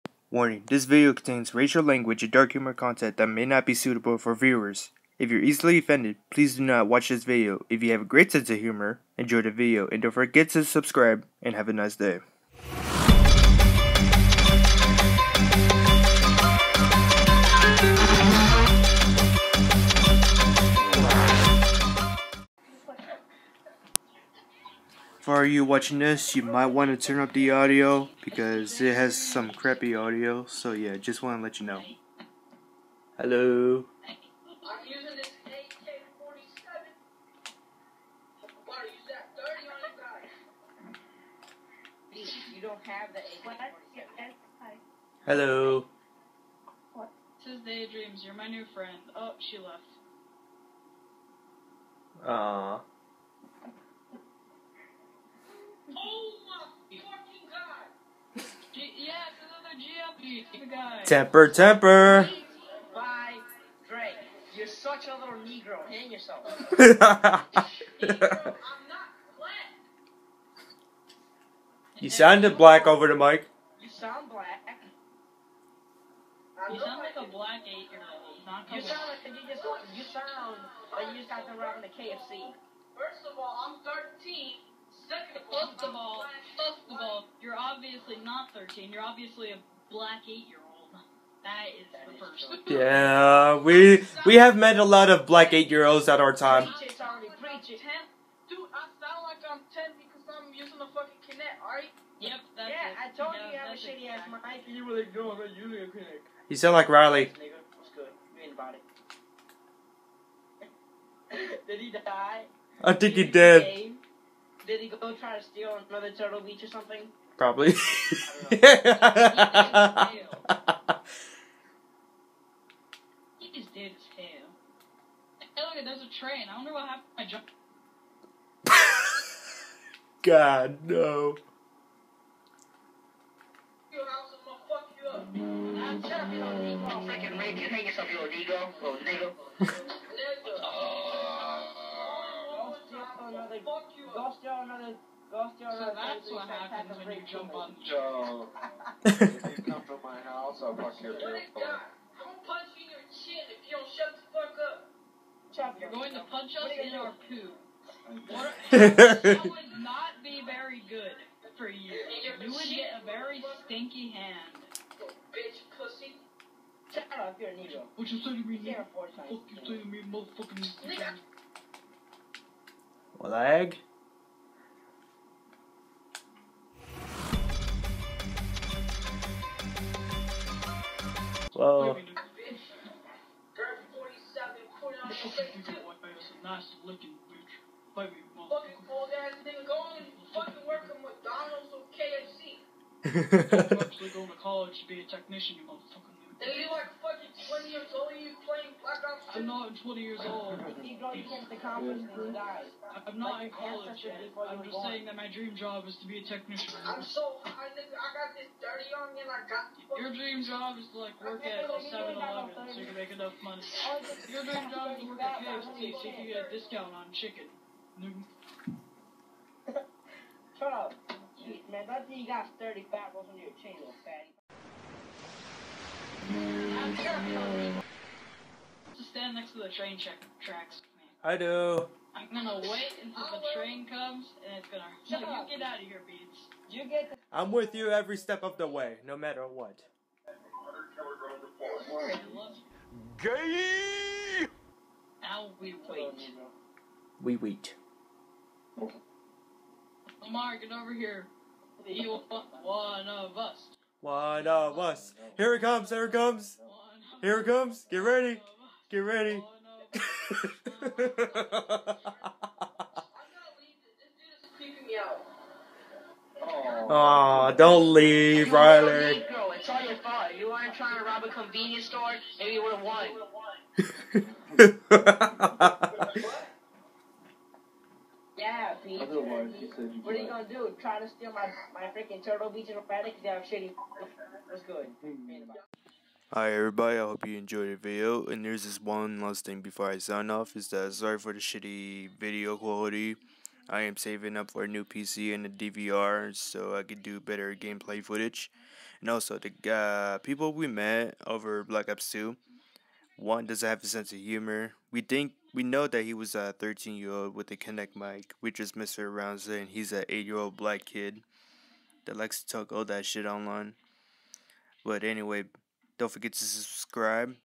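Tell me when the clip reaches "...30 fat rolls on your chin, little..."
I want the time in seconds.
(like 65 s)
222 s.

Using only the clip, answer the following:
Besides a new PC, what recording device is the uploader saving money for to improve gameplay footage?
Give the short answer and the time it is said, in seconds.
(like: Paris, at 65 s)
DVR, at 295 s.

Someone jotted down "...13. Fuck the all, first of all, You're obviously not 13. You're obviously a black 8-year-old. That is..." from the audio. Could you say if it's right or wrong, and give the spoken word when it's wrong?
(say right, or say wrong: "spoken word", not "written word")
right.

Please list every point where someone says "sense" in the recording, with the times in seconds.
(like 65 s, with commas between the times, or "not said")
8 s, 303 s.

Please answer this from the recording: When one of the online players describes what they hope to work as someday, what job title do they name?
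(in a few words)
Technician.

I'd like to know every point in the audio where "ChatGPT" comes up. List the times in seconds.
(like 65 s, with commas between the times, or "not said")
not said.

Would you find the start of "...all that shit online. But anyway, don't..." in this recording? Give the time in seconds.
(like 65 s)
312 s.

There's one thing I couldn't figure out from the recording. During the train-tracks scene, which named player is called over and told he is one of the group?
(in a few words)
Lamar.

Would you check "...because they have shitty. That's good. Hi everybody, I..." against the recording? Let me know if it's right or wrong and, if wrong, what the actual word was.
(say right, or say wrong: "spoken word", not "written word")
right.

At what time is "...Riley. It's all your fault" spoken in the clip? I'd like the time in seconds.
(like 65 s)
268 s.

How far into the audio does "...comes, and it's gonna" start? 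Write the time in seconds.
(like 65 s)
233 s.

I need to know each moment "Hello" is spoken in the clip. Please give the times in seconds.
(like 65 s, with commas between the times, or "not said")
33 s, 45 s.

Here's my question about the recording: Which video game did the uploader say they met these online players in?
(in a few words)
Black Ops 2.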